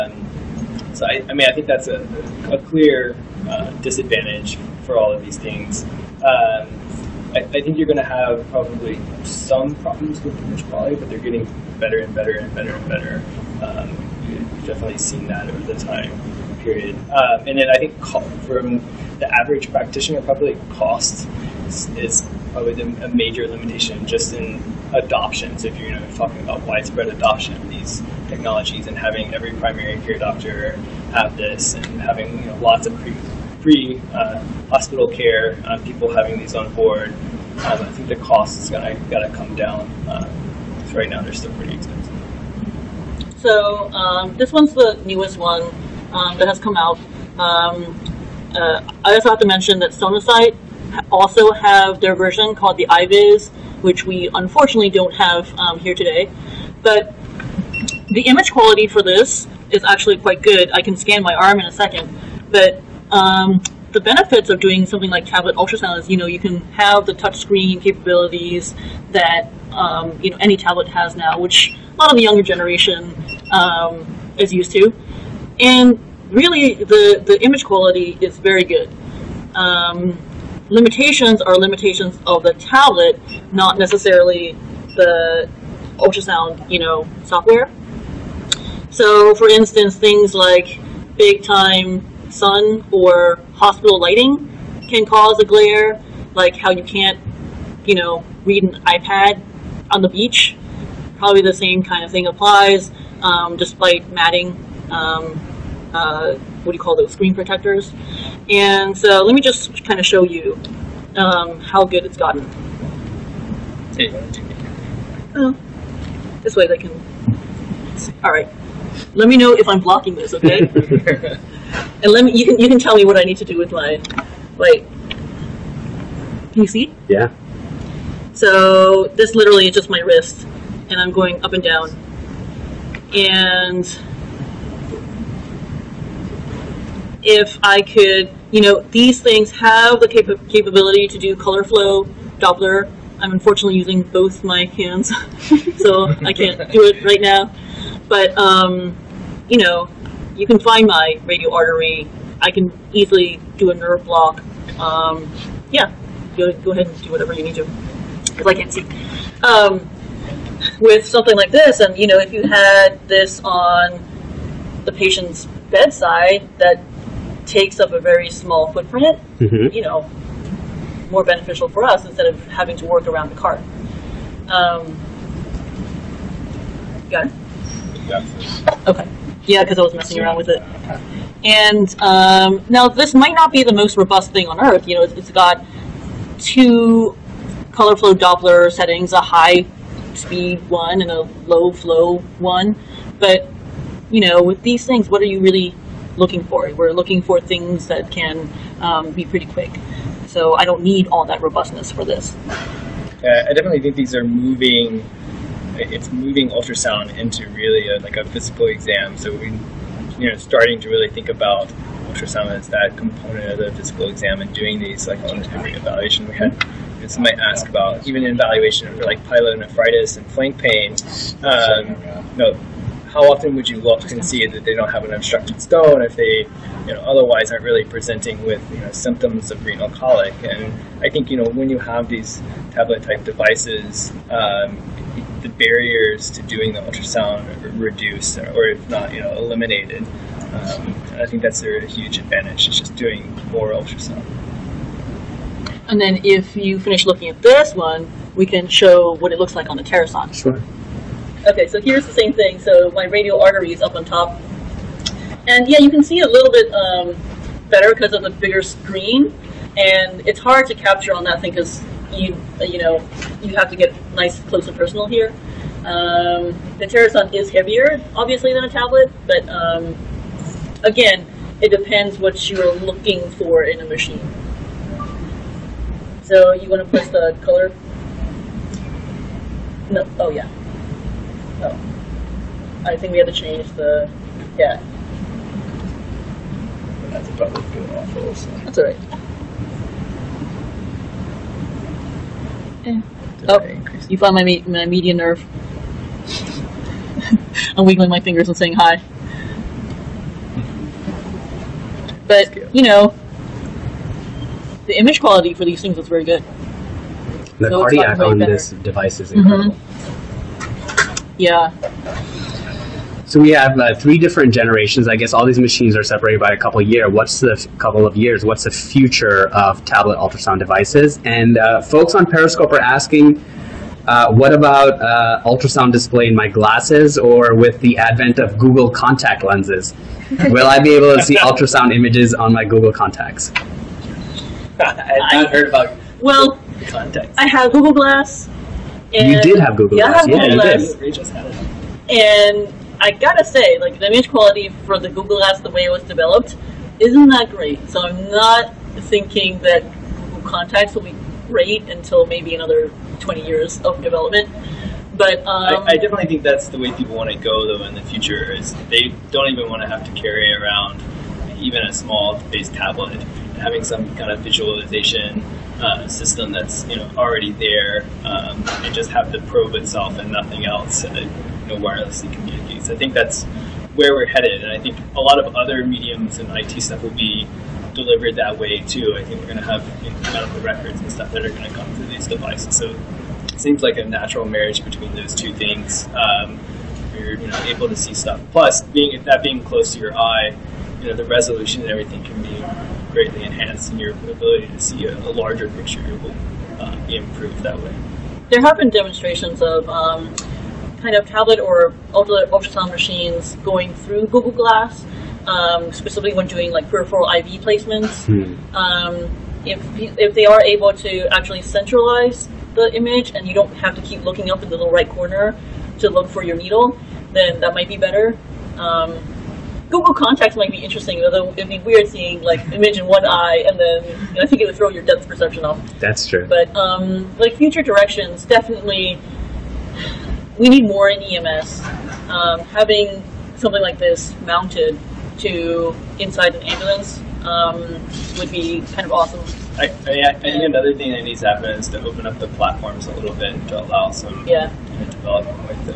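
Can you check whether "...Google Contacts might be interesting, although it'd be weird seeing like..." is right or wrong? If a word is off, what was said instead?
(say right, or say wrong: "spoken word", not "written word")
right.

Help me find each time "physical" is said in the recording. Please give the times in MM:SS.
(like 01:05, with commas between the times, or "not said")
03:28, 03:33.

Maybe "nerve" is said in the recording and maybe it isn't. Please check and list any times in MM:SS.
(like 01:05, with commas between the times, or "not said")
02:33, 04:55.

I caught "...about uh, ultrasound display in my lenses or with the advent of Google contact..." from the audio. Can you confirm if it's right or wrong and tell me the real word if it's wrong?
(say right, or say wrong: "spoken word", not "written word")
wrong: "glasses", not "lenses".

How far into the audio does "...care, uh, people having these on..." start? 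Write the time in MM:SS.
00:35.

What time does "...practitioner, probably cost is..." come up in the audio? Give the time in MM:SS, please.
00:19.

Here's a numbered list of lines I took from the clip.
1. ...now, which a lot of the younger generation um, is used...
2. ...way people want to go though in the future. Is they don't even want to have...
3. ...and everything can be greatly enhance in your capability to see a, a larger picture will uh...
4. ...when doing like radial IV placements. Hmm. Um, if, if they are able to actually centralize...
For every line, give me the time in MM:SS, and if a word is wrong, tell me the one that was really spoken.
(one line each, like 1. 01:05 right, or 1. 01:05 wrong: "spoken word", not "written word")
1. 01:11 right
2. 05:56 right
3. 06:31 wrong: "ability", not "capability"
4. 06:46 wrong: "peripheral", not "radial".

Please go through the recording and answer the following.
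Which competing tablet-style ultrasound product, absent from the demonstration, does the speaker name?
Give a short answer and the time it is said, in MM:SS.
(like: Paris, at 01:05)
iViz, at 00:52.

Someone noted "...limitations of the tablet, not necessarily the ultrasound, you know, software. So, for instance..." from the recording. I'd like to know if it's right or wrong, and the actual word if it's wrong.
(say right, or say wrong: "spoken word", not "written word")
right.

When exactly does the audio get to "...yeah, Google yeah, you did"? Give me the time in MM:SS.
05:40.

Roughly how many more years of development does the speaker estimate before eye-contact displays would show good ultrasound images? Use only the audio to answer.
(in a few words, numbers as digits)
20 years.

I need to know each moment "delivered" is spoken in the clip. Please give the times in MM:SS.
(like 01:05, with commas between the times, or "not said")
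06:17.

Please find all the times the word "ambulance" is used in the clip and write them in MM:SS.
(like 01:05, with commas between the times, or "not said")
07:16.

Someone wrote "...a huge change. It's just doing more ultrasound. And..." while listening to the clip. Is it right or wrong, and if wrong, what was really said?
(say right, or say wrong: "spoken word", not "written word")
wrong: "advantage", not "change".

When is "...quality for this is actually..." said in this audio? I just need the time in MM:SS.
00:58.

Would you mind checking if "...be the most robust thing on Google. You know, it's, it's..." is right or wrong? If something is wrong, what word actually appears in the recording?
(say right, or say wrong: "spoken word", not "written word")
wrong: "Earth", not "Google".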